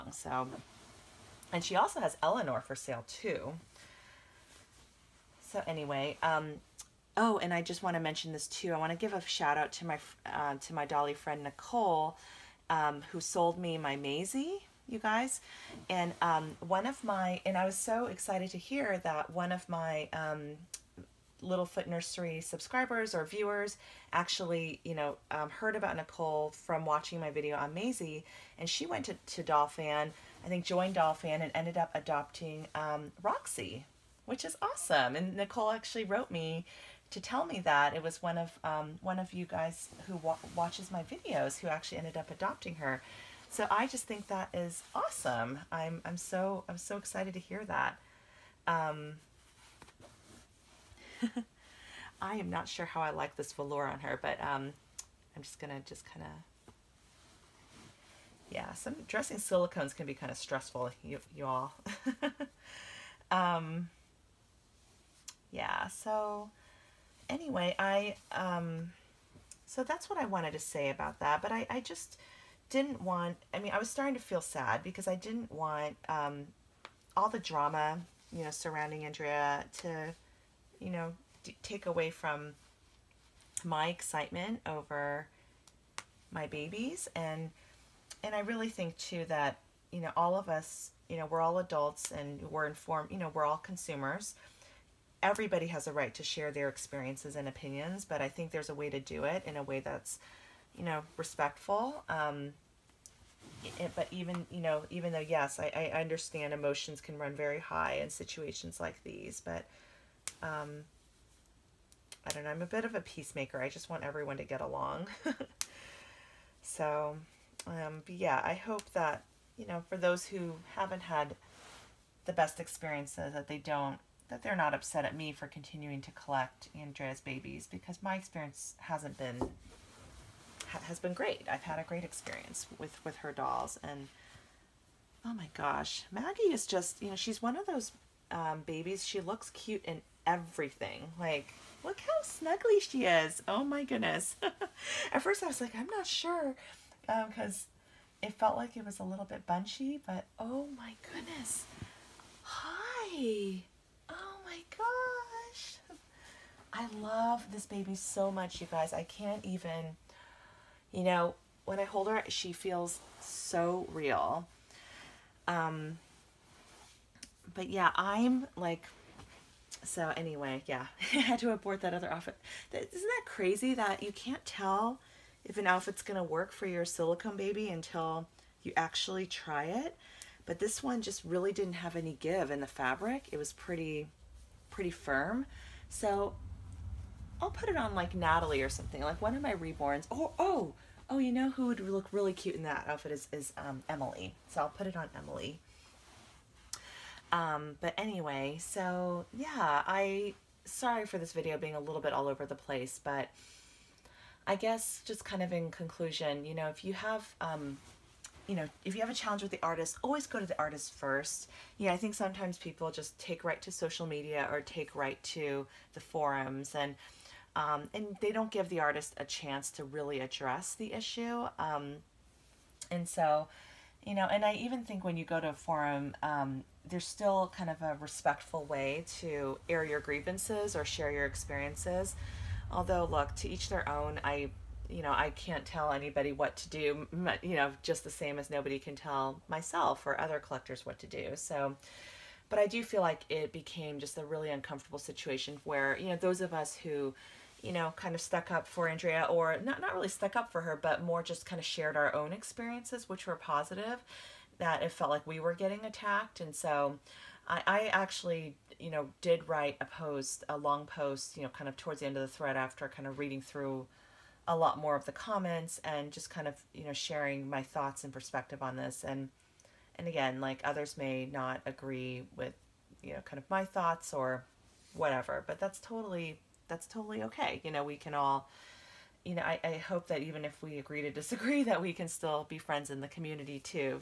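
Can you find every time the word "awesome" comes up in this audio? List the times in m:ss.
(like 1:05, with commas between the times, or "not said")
0:34, 0:44.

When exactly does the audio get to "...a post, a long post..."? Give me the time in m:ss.
4:19.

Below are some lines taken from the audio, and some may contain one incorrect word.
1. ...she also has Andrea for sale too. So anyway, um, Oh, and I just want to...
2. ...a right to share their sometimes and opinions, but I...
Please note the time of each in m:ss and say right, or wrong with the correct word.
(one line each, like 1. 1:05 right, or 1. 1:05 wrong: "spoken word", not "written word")
1. 0:01 wrong: "Eleanor", not "Andrea"
2. 1:35 wrong: "experiences", not "sometimes".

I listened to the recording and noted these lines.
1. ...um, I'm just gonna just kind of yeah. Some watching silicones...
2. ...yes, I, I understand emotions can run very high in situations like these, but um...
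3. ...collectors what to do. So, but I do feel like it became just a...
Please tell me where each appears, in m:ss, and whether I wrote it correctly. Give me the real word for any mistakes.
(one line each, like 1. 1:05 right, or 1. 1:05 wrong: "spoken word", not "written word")
1. 0:54 wrong: "dressing", not "watching"
2. 1:45 right
3. 4:00 right.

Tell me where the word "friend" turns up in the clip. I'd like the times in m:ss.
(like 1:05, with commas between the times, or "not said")
0:11, 4:42.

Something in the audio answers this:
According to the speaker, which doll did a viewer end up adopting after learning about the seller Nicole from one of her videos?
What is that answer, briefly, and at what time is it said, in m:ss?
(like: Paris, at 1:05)
Roxy, at 0:33.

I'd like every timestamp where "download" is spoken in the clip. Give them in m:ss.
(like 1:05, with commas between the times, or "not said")
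not said.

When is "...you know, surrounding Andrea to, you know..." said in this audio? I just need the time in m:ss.
1:18.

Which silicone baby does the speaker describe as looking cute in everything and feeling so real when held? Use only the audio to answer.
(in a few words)
Maggie.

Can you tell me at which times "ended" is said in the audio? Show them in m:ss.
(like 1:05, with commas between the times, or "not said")
0:31, 0:41.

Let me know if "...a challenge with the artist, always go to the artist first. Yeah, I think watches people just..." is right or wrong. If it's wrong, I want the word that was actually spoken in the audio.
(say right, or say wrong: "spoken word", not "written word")
wrong: "sometimes", not "watches".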